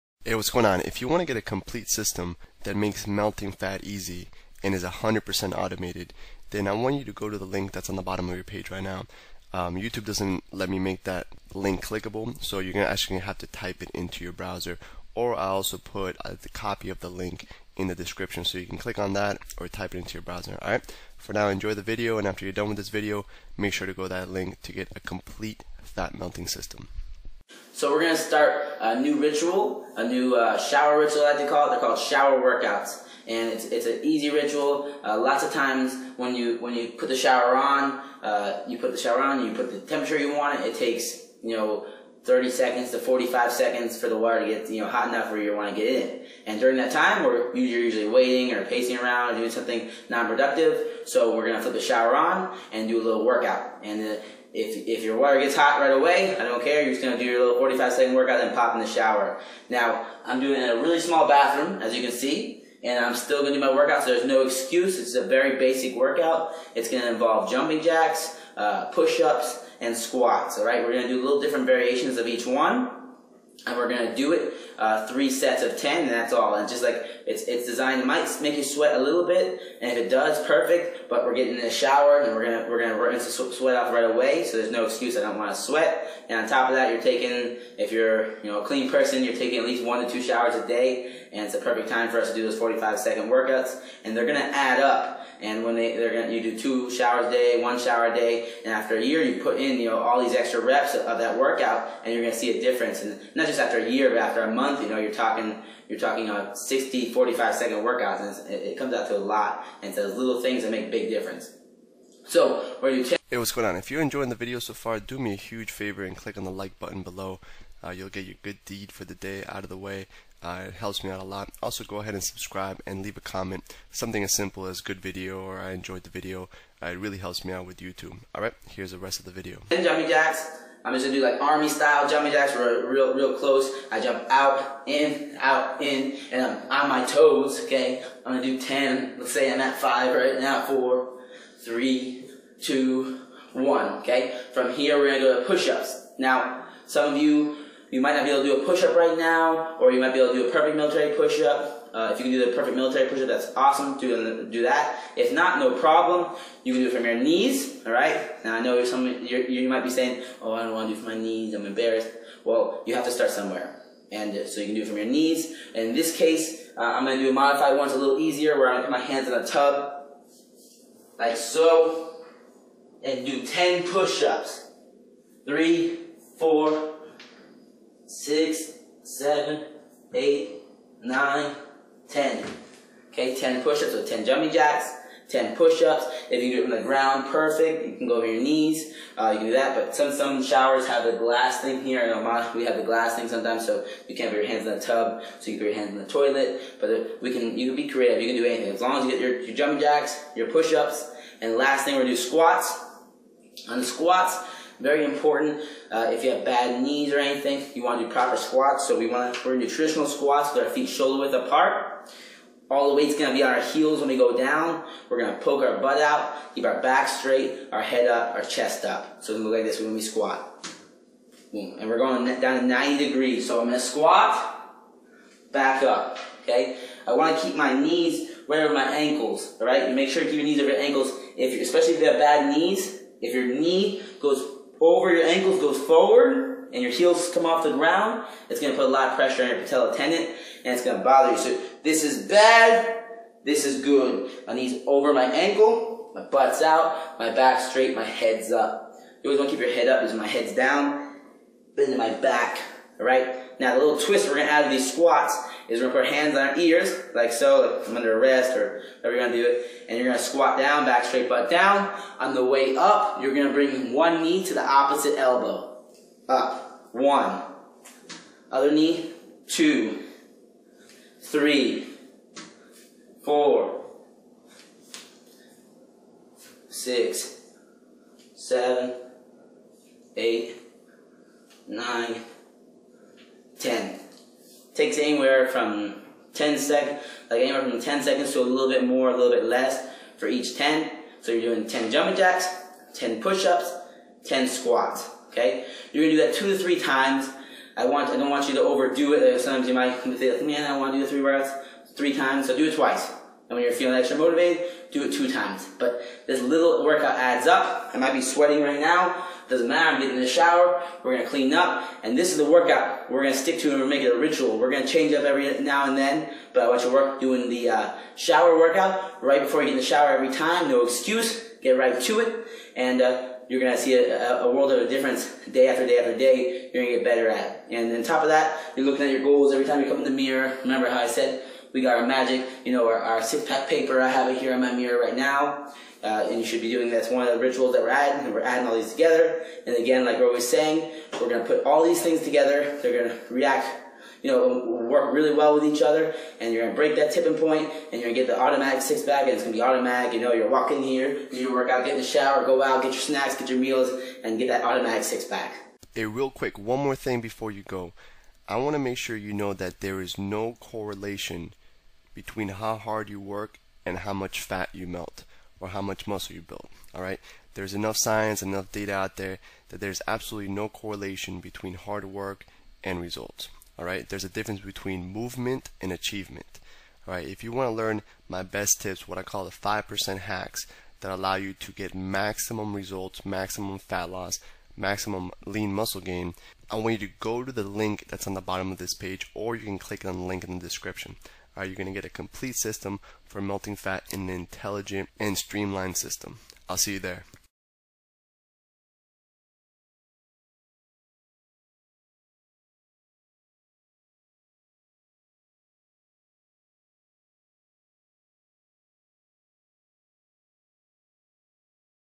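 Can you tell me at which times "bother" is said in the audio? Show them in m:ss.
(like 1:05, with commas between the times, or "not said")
4:01.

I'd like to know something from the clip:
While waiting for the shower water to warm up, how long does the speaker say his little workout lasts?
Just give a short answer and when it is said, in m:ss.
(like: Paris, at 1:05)
45 seconds, at 0:57.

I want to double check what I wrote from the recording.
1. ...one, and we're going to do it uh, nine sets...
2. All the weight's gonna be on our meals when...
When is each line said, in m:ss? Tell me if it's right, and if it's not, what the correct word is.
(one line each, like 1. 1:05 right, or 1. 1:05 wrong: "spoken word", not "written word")
1. 1:12 wrong: "three", not "nine"
2. 3:32 wrong: "heels", not "meals".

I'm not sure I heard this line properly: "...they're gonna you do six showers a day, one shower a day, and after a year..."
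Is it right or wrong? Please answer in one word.
wrong.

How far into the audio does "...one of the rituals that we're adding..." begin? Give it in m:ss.
5:37.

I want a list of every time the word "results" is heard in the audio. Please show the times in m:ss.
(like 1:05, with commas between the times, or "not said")
6:13, 6:22.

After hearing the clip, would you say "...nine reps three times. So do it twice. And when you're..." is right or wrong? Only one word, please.
wrong.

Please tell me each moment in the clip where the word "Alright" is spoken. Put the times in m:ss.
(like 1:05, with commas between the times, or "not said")
2:08, 3:49.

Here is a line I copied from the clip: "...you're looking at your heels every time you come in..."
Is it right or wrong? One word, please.
wrong.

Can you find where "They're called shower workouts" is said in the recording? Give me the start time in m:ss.
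0:31.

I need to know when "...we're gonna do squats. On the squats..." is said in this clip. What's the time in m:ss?
3:21.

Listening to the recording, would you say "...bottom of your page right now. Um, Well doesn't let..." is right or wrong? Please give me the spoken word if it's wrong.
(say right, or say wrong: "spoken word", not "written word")
wrong: "YouTube", not "Well".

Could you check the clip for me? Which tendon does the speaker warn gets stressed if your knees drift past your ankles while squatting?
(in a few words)
patella tendon.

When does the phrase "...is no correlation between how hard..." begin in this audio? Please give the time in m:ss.
6:00.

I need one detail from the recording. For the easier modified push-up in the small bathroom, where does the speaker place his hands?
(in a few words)
in a tub.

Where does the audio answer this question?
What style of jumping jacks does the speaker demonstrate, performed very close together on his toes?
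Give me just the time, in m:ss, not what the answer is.
2:11.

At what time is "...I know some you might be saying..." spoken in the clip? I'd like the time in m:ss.
2:38.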